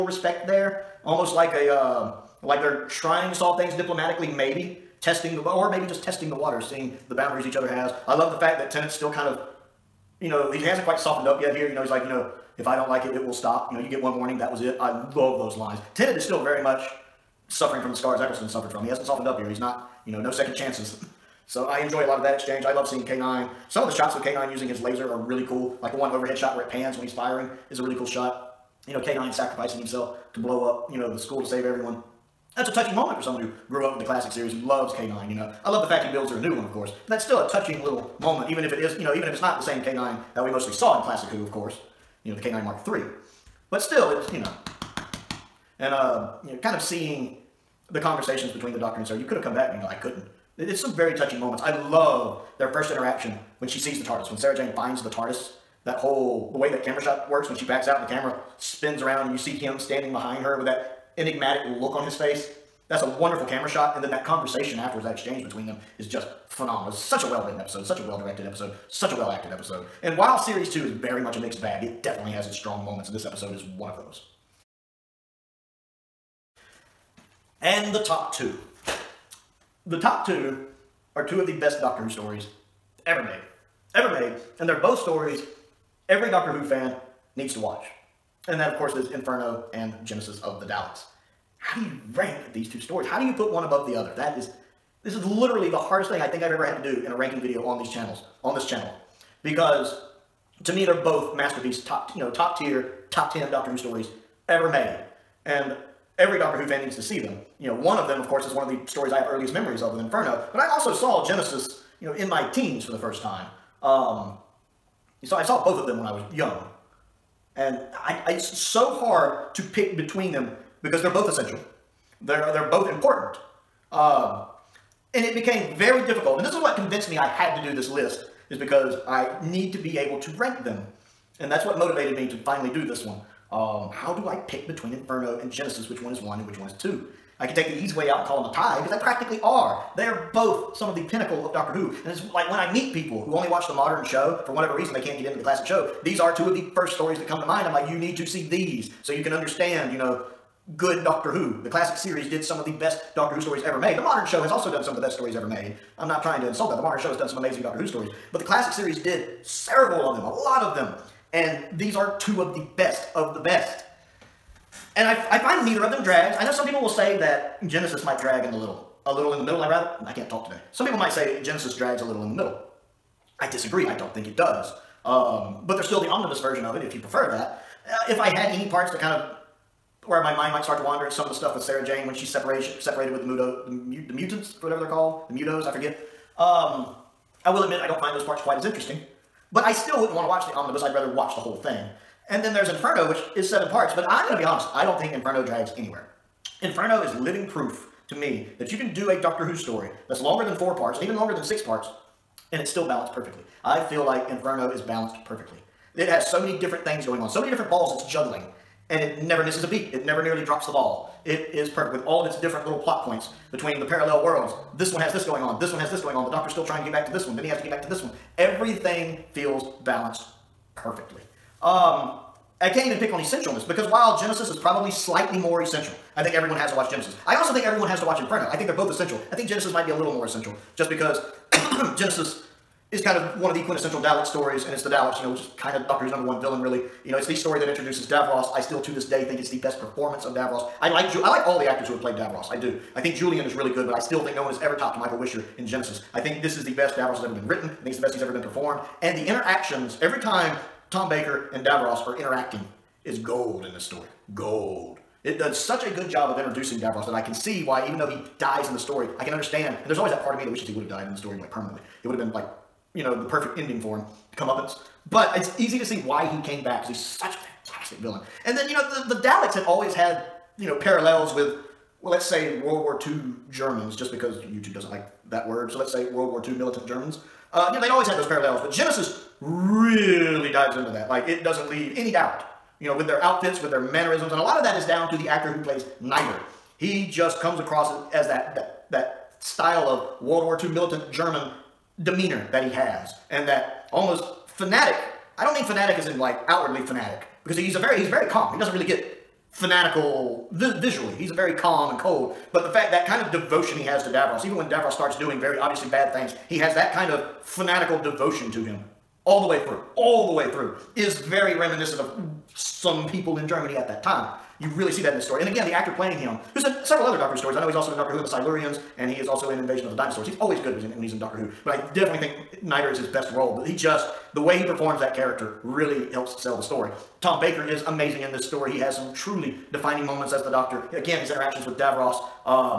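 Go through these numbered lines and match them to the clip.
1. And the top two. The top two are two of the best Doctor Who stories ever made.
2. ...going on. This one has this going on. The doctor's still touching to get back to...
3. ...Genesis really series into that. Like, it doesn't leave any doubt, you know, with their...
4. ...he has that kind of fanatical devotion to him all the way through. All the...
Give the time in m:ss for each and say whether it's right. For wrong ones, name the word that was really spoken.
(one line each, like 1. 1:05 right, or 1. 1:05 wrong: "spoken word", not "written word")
1. 1:17 right
2. 3:35 wrong: "trying", not "touching"
3. 4:38 wrong: "dives", not "series"
4. 5:06 right.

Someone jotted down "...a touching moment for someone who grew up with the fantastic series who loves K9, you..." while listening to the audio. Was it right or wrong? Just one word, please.
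wrong.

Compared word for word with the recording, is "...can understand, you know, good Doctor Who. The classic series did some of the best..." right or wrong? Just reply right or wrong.
right.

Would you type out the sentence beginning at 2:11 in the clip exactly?
And that's what motivated me to finally do this one.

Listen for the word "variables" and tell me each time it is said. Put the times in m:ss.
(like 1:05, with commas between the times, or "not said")
not said.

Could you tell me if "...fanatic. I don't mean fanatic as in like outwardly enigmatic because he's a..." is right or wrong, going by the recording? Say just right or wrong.
wrong.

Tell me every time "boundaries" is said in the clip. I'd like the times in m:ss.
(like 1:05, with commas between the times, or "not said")
0:07.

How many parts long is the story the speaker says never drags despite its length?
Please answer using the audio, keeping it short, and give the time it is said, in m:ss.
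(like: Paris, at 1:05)
7, at 3:13.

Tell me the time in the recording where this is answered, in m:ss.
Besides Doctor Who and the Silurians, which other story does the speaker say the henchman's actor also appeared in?
5:19.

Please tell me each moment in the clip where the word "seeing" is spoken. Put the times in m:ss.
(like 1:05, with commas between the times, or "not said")
0:06, 0:22, 0:46.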